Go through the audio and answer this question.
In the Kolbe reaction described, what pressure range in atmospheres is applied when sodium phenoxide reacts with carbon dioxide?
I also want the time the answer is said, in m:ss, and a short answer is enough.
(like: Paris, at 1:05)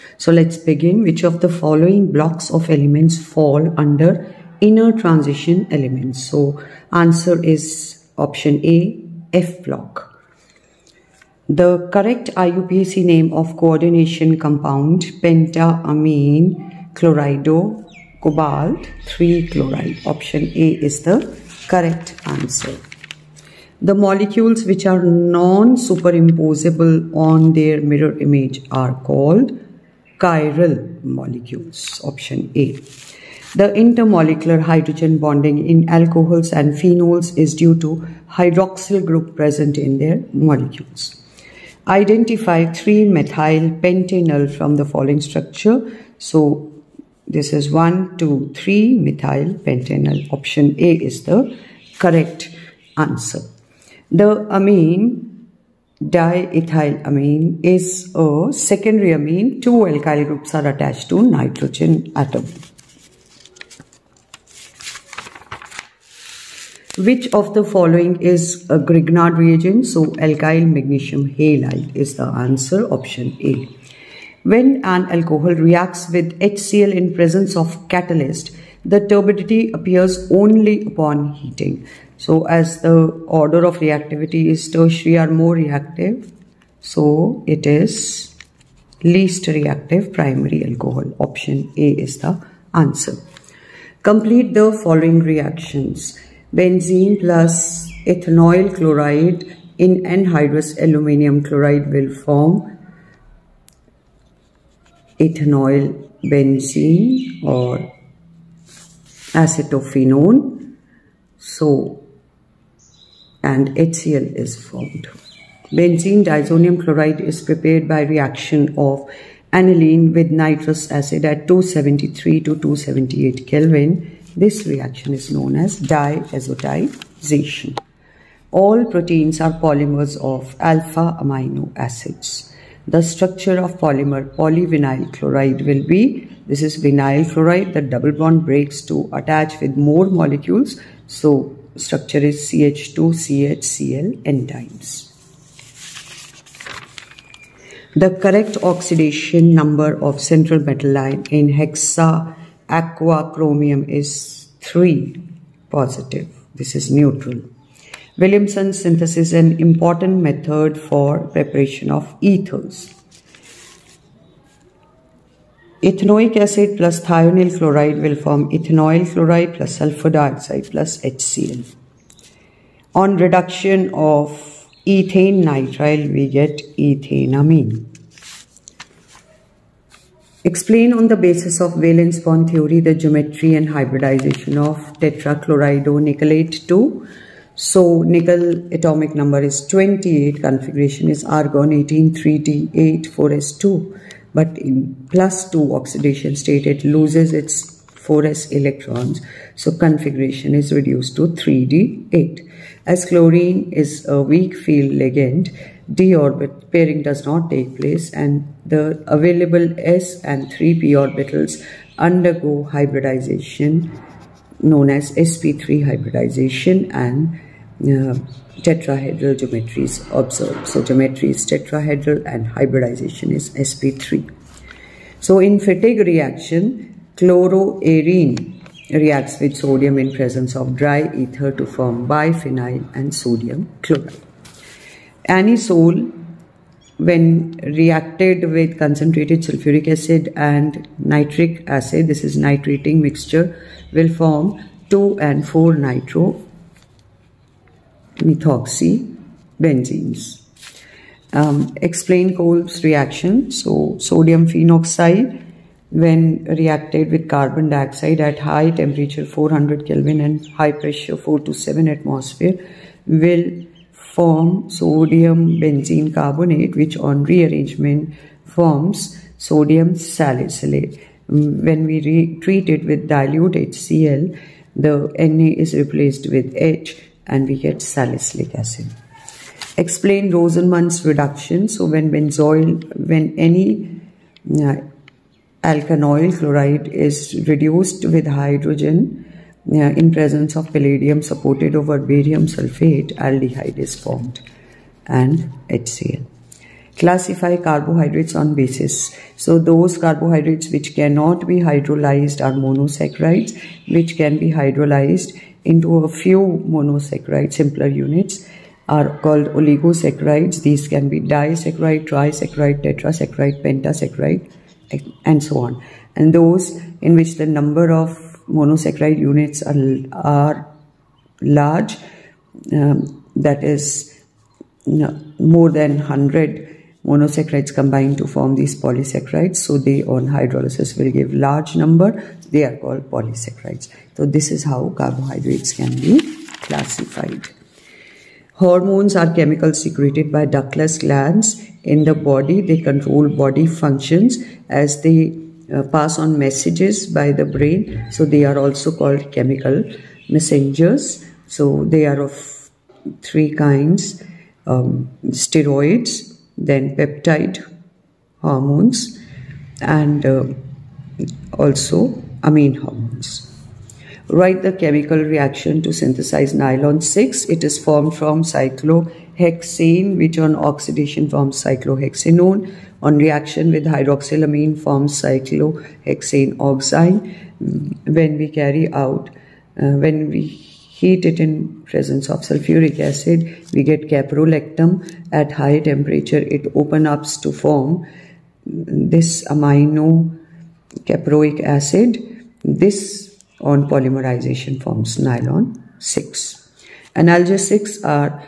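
4 to 7 atmospheres, at 4:21.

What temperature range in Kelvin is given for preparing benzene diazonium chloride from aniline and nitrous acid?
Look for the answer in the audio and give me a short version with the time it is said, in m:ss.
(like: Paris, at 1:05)
273 to 278 Kelvin, at 2:01.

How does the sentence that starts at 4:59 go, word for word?
So those carbohydrates which cannot be hydrolyzed are monosaccharides, which can be hydrolyzed into a few monosaccharide simpler units are called oligosaccharides.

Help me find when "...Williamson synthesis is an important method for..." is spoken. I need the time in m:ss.
2:38.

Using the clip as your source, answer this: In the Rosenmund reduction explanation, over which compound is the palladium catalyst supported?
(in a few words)
barium sulfate.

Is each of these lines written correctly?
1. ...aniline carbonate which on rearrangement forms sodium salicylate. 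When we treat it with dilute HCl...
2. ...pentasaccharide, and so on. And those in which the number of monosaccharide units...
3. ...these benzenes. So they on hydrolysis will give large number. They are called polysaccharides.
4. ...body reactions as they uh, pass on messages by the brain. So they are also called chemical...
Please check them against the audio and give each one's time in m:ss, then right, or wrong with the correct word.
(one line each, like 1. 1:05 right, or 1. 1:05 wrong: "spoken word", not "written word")
1. 4:25 wrong: "benzene", not "aniline"
2. 5:13 right
3. 5:28 wrong: "polysaccharides", not "benzenes"
4. 5:43 wrong: "functions", not "reactions".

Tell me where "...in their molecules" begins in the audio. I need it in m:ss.
0:39.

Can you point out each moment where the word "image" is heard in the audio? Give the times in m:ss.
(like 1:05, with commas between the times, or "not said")
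0:28.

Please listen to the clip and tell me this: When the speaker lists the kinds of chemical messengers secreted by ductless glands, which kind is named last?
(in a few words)
amine hormones.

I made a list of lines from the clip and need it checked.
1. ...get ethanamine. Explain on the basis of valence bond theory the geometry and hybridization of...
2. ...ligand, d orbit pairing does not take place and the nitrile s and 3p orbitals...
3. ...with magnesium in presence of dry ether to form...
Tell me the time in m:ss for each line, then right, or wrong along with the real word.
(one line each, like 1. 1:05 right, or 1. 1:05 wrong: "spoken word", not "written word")
1. 2:56 right
2. 3:24 wrong: "available", not "nitrile"
3. 3:49 wrong: "sodium", not "magnesium".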